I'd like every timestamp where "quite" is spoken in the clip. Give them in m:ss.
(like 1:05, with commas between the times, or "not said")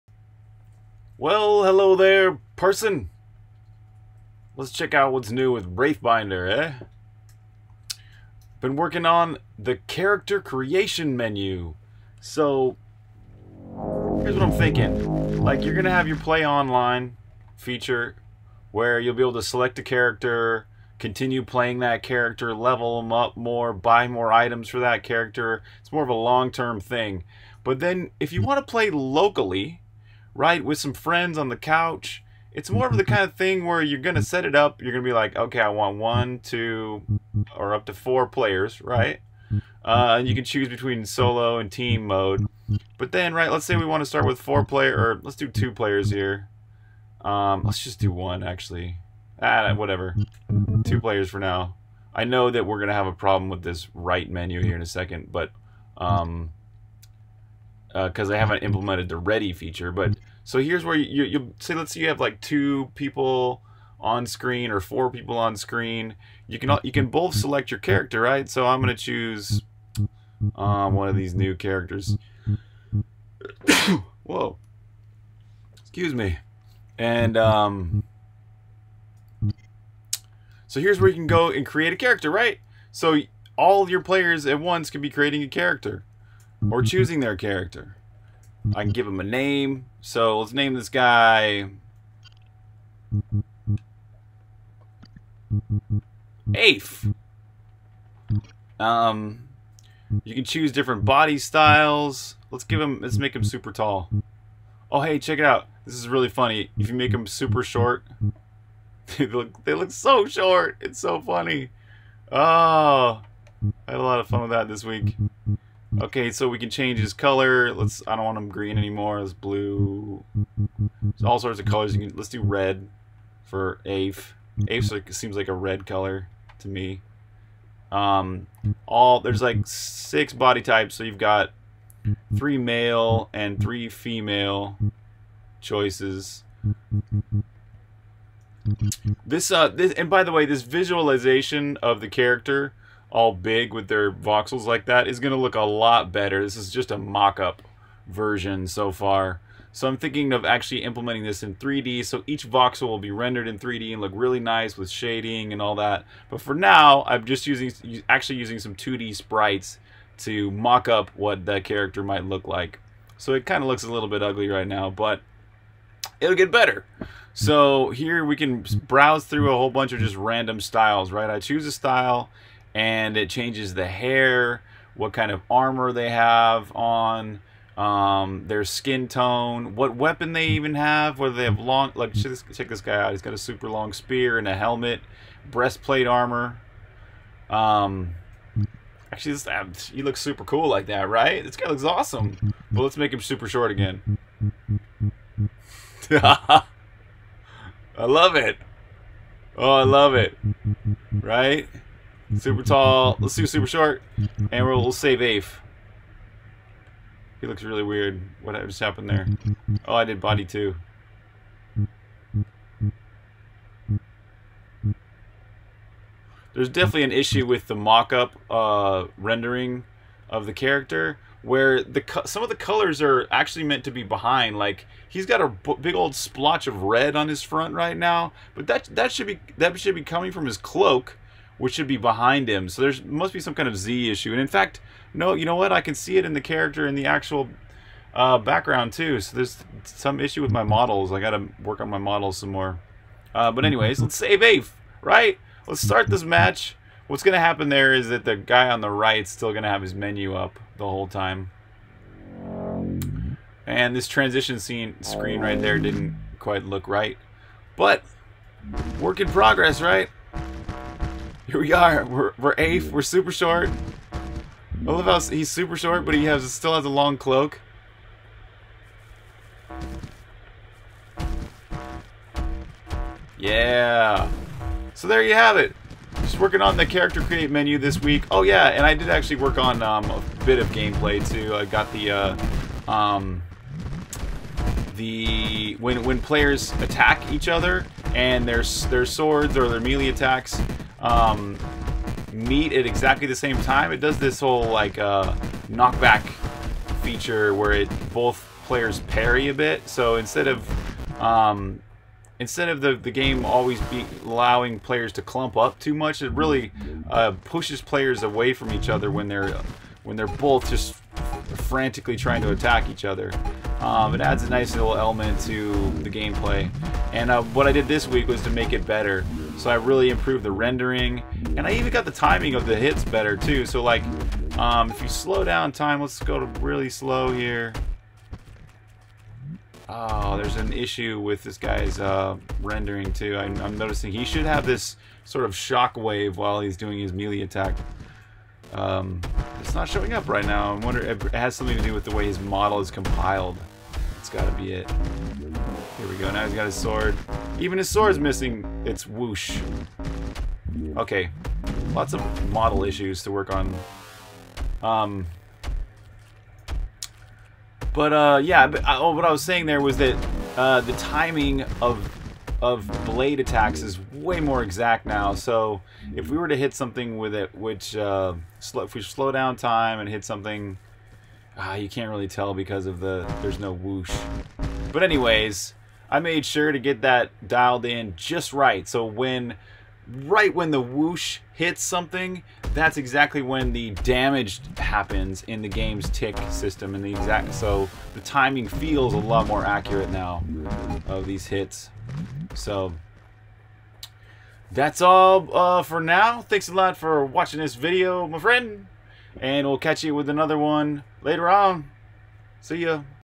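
4:16.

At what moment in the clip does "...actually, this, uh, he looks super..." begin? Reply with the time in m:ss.
3:09.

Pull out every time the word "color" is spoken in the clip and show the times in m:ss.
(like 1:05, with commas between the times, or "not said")
1:57, 2:01, 2:05, 3:42.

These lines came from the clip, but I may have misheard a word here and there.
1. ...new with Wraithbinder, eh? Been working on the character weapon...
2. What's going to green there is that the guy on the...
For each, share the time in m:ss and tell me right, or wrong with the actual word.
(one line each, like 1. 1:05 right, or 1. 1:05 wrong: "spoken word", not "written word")
1. 0:05 wrong: "creation", not "weapon"
2. 4:07 wrong: "happen", not "green".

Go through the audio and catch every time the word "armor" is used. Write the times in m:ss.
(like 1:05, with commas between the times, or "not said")
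2:55, 3:06.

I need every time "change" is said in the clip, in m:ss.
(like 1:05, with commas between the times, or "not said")
1:56, 2:53.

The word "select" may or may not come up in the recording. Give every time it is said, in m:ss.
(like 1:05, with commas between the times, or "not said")
0:19, 1:07.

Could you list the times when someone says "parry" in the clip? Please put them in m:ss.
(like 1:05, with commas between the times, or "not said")
4:59.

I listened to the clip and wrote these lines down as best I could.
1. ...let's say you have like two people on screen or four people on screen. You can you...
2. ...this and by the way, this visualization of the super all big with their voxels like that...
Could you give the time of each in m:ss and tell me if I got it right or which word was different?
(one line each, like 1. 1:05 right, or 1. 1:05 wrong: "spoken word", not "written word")
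1. 1:01 right
2. 2:19 wrong: "character", not "super".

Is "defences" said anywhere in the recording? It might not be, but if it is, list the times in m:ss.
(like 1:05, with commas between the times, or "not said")
not said.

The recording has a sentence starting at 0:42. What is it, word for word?
But then, right, let's say we want to start with four player, or let's do two players here.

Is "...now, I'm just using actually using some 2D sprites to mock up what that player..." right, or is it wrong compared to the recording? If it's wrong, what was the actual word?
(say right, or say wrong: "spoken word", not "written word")
wrong: "character", not "player".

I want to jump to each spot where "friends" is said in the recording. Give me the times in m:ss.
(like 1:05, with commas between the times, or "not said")
0:30, 6:38.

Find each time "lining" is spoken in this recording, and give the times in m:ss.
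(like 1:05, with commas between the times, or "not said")
not said.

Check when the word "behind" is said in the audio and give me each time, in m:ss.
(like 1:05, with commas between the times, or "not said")
3:44, 3:51.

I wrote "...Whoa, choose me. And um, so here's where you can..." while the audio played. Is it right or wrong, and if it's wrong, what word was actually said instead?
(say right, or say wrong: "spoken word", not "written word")
wrong: "excuse", not "choose".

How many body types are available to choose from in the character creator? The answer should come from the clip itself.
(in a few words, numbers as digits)
6.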